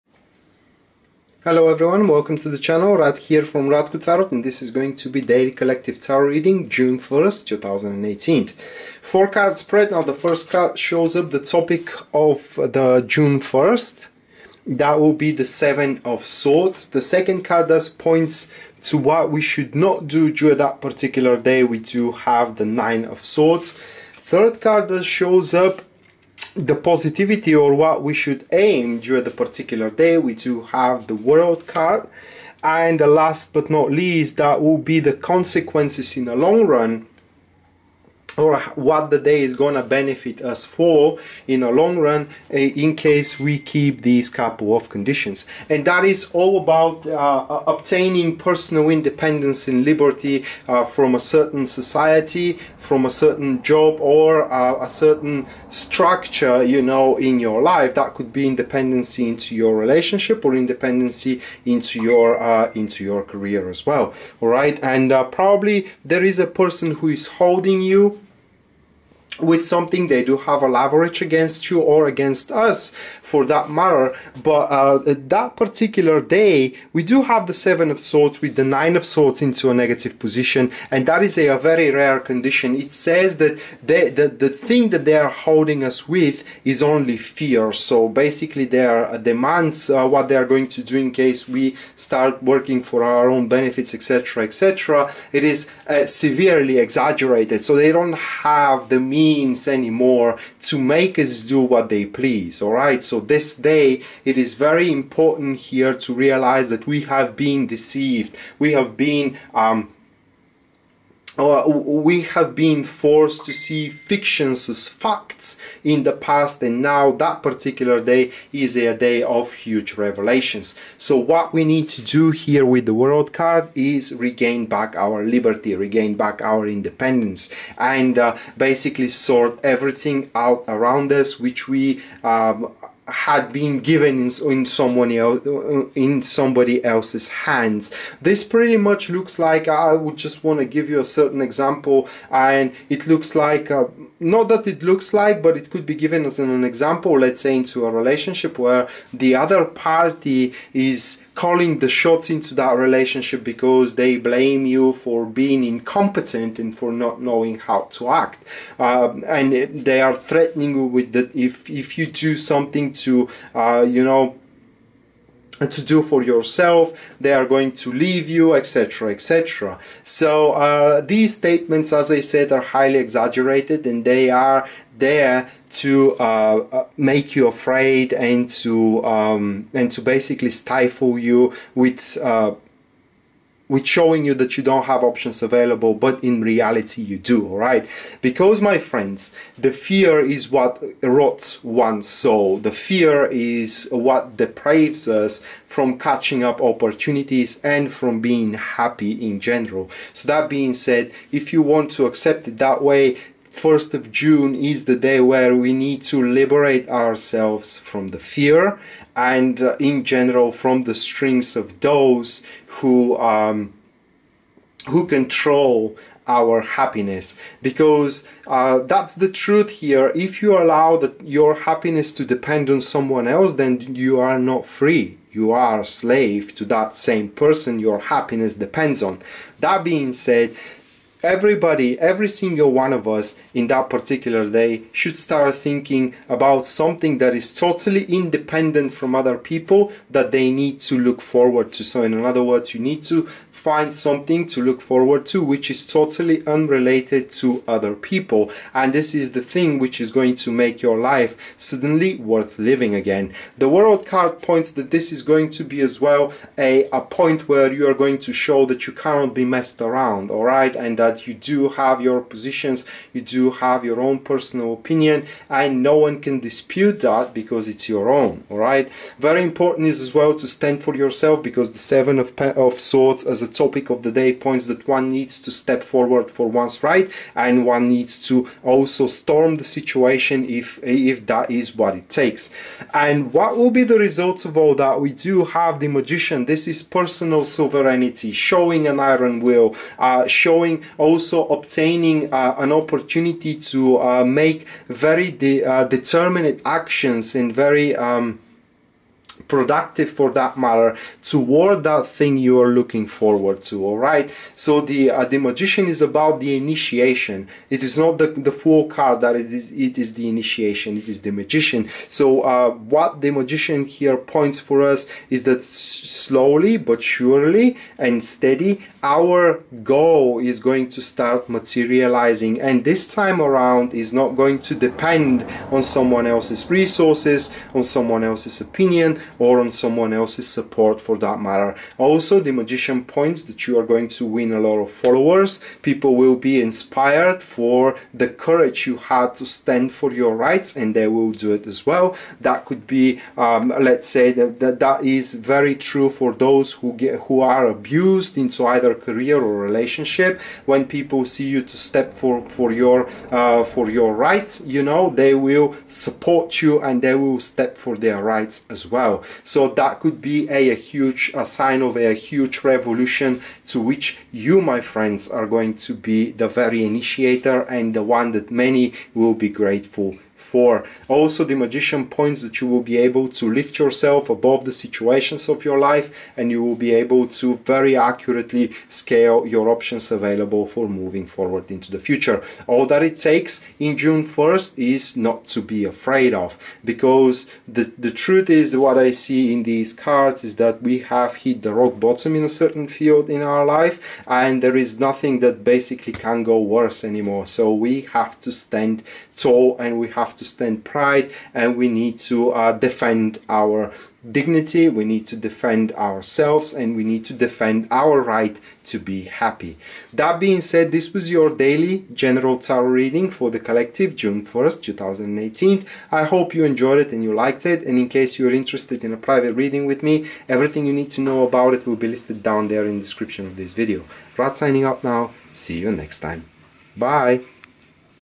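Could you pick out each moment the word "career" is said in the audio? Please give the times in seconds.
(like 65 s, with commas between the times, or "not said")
63 s, 348 s.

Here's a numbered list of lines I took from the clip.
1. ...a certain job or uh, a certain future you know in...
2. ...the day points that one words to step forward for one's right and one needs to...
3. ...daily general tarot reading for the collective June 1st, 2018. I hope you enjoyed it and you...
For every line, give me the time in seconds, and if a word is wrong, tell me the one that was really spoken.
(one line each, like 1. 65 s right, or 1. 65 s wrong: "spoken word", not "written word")
1. 53 s wrong: "structure", not "future"
2. 274 s wrong: "needs", not "words"
3. 411 s right.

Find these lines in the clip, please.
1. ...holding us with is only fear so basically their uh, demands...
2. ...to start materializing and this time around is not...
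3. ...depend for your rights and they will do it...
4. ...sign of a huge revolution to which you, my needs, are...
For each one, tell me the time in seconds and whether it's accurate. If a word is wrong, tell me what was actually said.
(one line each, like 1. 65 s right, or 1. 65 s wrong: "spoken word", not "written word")
1. 85 s right
2. 320 s right
3. 339 s wrong: "stand", not "depend"
4. 361 s wrong: "friends", not "needs".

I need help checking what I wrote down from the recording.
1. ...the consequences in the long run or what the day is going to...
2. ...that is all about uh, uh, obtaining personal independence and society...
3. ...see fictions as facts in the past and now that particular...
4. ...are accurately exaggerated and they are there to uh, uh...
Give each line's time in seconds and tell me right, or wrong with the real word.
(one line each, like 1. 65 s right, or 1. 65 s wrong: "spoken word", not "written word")
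1. 34 s right
2. 45 s wrong: "liberty", not "society"
3. 113 s right
4. 172 s wrong: "highly", not "accurately".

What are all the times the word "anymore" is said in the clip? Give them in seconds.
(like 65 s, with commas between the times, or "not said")
99 s, 397 s.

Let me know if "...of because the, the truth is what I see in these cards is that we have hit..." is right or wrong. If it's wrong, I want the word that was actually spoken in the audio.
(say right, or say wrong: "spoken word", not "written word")
right.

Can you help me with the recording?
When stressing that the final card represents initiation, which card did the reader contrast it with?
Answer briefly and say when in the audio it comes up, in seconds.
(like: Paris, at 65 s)
The Fool, at 308 s.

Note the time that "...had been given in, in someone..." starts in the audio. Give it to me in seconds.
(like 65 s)
133 s.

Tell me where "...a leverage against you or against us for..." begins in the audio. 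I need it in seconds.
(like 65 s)
70 s.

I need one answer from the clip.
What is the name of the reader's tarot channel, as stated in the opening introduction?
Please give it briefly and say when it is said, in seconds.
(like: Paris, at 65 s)
Rad Tarot, at 3 s.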